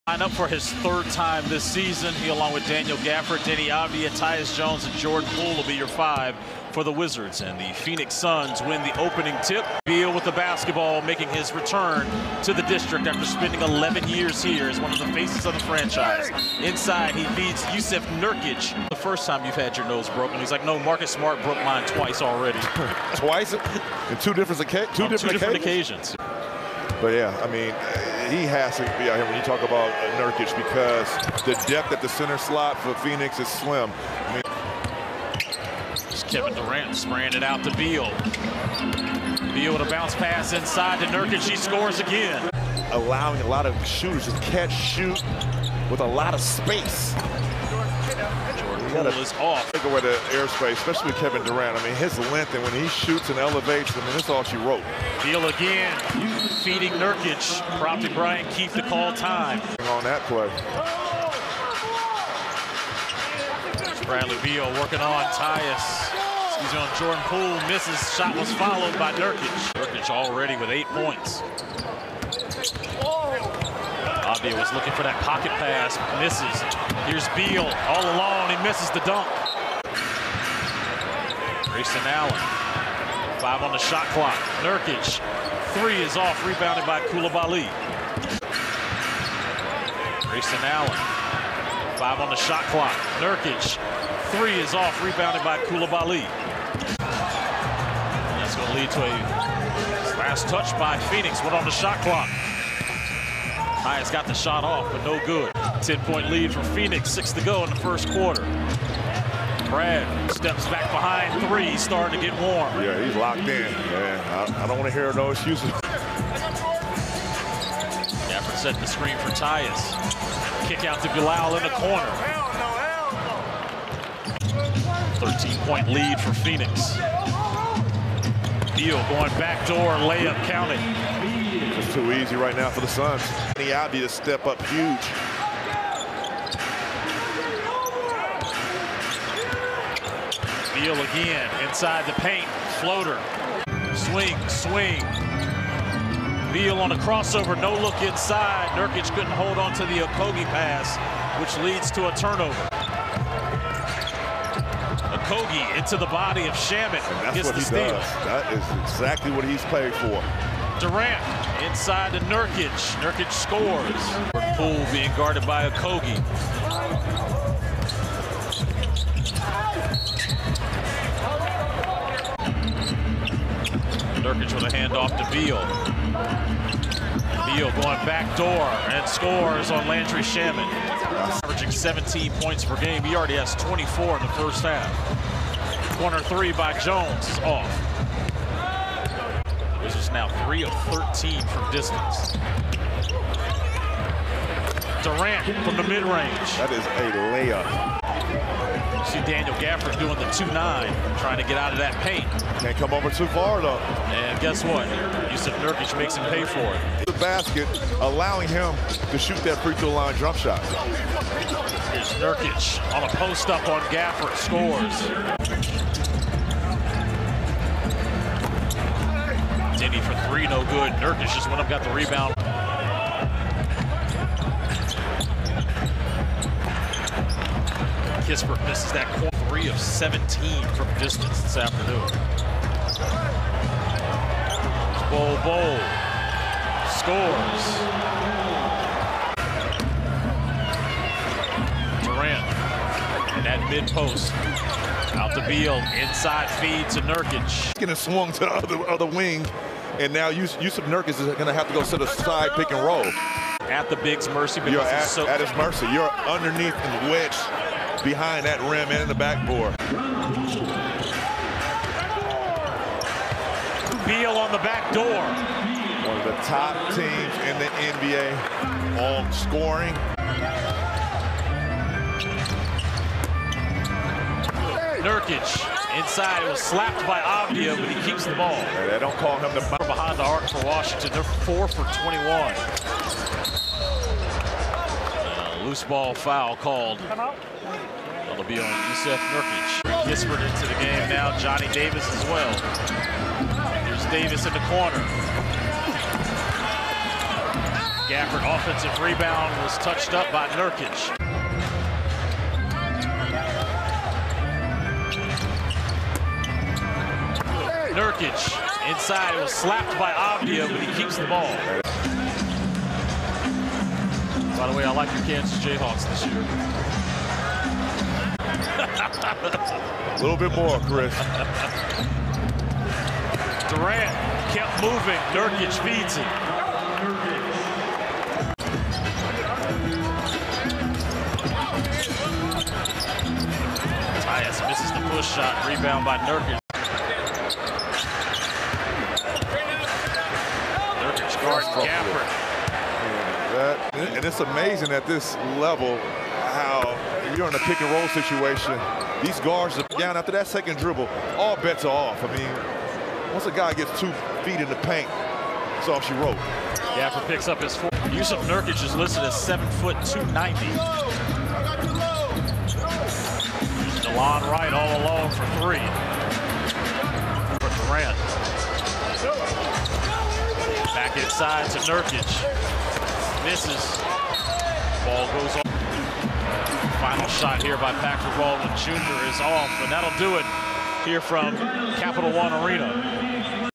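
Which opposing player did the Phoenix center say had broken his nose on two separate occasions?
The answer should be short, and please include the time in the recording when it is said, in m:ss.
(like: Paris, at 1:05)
Marcus Smart, at 0:20.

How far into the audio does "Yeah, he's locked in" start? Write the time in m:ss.
1:52.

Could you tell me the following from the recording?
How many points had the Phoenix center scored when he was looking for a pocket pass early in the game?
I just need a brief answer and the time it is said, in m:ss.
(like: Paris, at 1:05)
8, at 1:10.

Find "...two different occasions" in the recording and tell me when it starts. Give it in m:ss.
0:24.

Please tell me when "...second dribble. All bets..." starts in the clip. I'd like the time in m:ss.
5:50.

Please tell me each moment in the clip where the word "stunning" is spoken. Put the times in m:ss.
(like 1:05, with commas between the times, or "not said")
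not said.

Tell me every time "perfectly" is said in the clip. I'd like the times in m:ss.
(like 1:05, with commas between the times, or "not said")
not said.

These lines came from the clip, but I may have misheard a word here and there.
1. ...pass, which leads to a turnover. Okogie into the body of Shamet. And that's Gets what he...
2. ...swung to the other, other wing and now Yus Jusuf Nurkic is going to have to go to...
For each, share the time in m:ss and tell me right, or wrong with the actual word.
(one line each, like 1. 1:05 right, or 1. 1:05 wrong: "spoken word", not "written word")
1. 2:30 right
2. 4:07 right.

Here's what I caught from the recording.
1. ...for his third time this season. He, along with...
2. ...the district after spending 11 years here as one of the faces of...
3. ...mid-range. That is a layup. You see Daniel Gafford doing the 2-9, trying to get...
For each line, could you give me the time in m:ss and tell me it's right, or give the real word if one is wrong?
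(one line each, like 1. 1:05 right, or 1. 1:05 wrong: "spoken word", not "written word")
1. 0:00 right
2. 0:12 right
3. 3:15 right.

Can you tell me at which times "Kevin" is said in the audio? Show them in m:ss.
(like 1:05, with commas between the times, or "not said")
0:36, 0:51.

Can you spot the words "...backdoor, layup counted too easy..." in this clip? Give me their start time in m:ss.
2:09.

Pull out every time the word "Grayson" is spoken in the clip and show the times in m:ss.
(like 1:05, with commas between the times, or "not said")
1:21, 1:30.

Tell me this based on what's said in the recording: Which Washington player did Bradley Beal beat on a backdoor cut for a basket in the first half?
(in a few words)
Landry Shamet.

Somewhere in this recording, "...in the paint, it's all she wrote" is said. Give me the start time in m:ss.
5:54.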